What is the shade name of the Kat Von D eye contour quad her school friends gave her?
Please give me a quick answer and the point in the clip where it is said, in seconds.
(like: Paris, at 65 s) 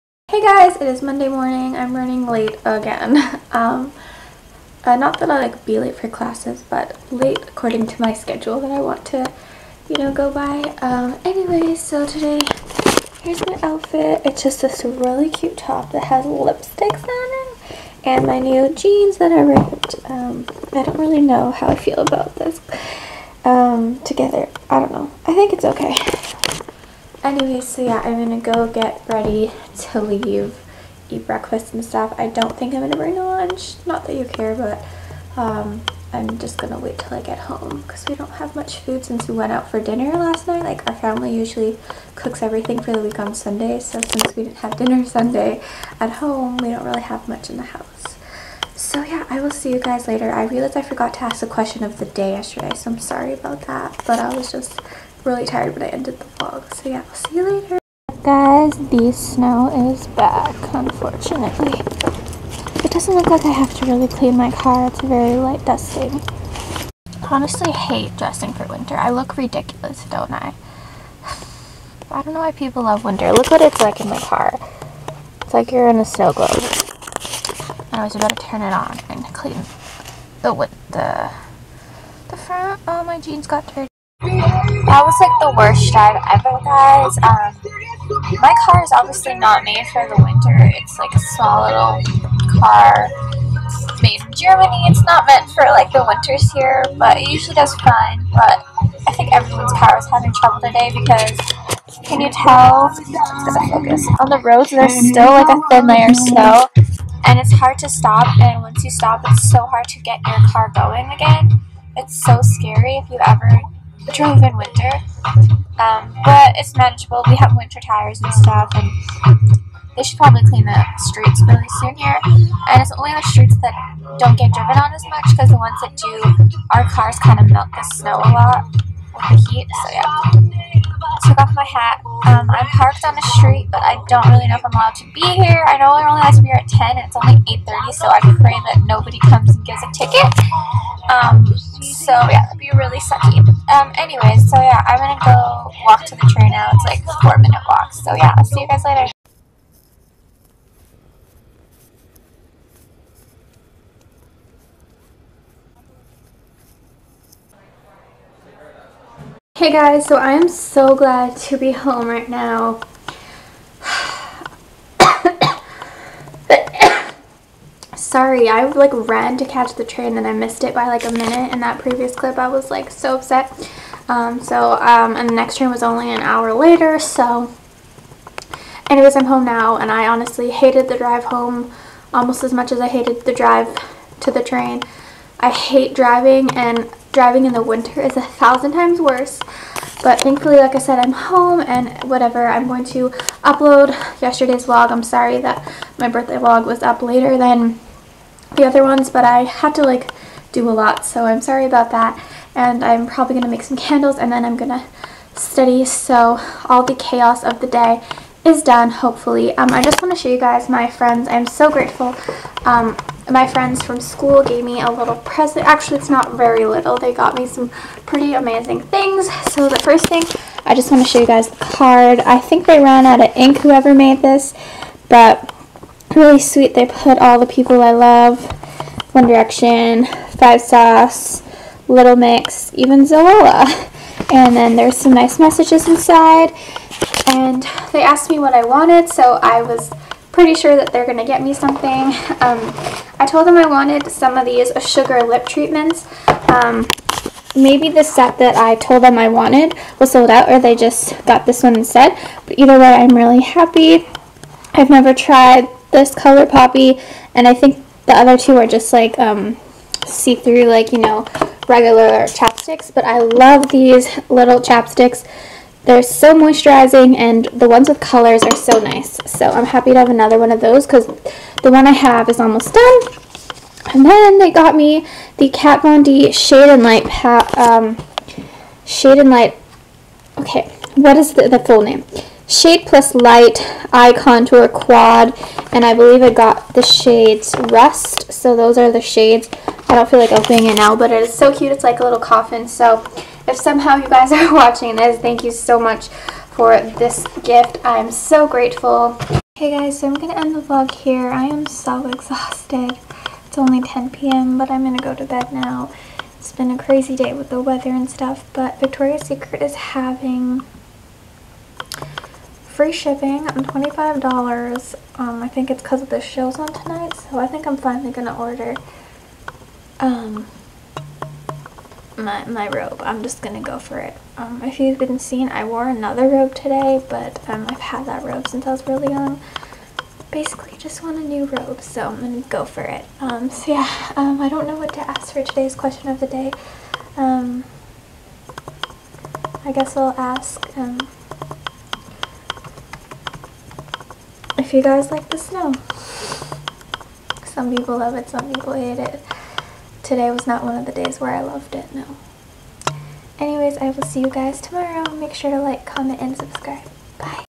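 Rust, at 287 s.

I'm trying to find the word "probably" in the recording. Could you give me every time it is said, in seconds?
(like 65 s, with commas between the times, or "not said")
120 s, 203 s.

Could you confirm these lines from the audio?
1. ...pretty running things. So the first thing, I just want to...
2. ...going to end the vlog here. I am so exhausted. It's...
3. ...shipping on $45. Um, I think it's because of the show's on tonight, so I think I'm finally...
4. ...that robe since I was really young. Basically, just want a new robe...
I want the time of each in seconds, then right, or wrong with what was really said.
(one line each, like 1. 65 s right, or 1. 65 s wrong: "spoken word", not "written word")
1. 218 s wrong: "amazing", not "running"
2. 300 s right
3. 312 s wrong: "25", not "45"
4. 328 s right.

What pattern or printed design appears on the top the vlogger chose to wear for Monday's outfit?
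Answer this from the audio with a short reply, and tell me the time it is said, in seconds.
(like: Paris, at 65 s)
Lipsticks, at 16 s.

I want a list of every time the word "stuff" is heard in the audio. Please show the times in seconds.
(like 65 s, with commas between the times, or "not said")
31 s, 118 s, 308 s.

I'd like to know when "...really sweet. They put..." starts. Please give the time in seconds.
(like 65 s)
226 s.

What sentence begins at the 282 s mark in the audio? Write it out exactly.
Shade plus Light Eye Contour Quad.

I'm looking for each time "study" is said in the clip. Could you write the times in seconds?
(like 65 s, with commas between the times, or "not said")
205 s.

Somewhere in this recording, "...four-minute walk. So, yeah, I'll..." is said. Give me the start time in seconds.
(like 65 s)
147 s.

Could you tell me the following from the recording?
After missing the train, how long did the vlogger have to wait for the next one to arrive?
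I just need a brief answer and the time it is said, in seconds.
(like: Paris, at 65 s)
An hour, at 176 s.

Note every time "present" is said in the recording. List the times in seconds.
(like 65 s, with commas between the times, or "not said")
215 s.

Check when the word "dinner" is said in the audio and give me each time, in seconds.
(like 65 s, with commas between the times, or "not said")
39 s, 44 s.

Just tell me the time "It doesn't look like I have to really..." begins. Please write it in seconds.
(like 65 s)
62 s.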